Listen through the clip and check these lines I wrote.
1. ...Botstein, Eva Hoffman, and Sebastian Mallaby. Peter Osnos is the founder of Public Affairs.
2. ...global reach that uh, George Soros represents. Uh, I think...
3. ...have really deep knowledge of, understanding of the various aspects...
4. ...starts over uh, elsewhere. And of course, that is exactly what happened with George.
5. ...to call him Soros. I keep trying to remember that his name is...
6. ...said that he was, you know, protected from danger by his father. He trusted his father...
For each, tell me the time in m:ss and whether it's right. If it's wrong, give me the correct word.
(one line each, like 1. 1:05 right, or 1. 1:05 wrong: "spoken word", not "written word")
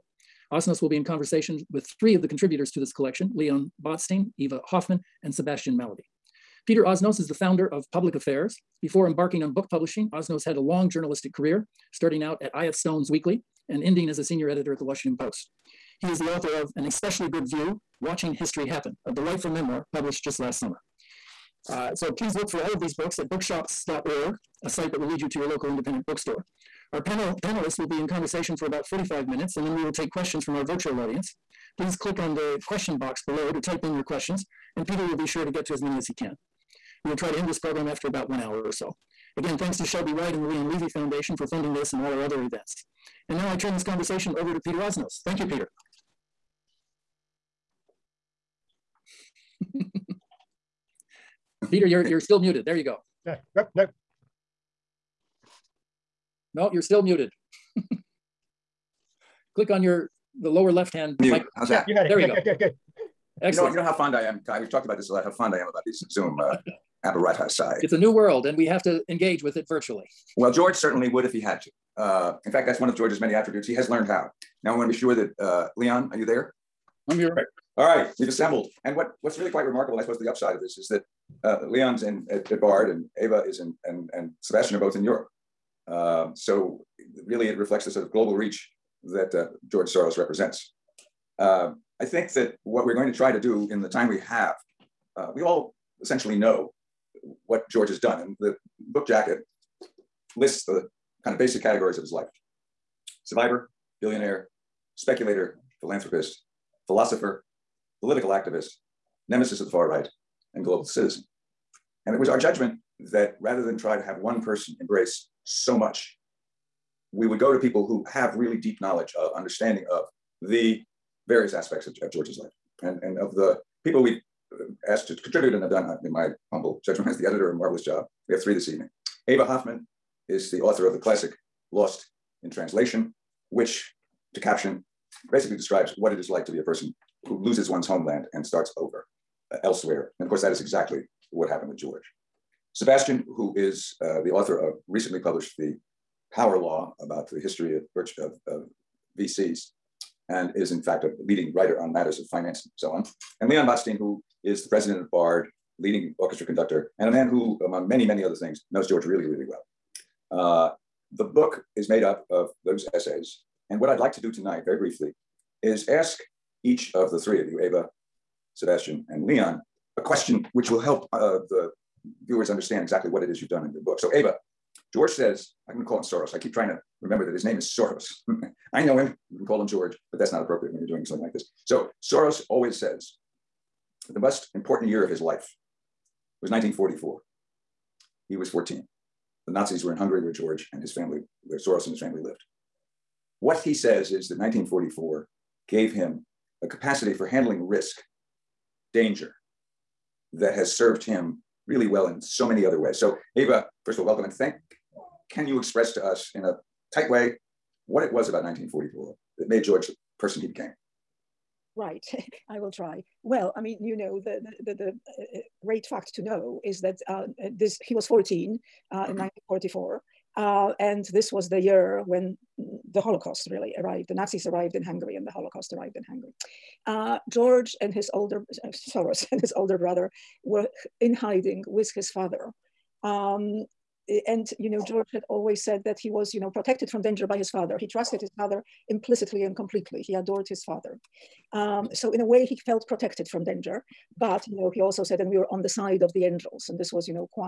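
1. 0:03 right
2. 1:28 right
3. 1:58 right
4. 2:18 right
5. 2:55 right
6. 3:55 right.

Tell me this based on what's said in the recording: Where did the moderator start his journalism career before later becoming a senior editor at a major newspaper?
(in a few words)
IF Stone's Weekly.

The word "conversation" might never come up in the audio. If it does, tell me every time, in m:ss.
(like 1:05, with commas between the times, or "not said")
0:01, 0:28, 0:43.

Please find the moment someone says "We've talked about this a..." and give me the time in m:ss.
1:04.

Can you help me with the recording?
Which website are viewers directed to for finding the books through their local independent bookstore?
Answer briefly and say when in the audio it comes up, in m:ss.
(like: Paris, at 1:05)
bookshops.org, at 0:23.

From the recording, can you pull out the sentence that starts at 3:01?
So, Soros always says, the most important year of his life was 1944.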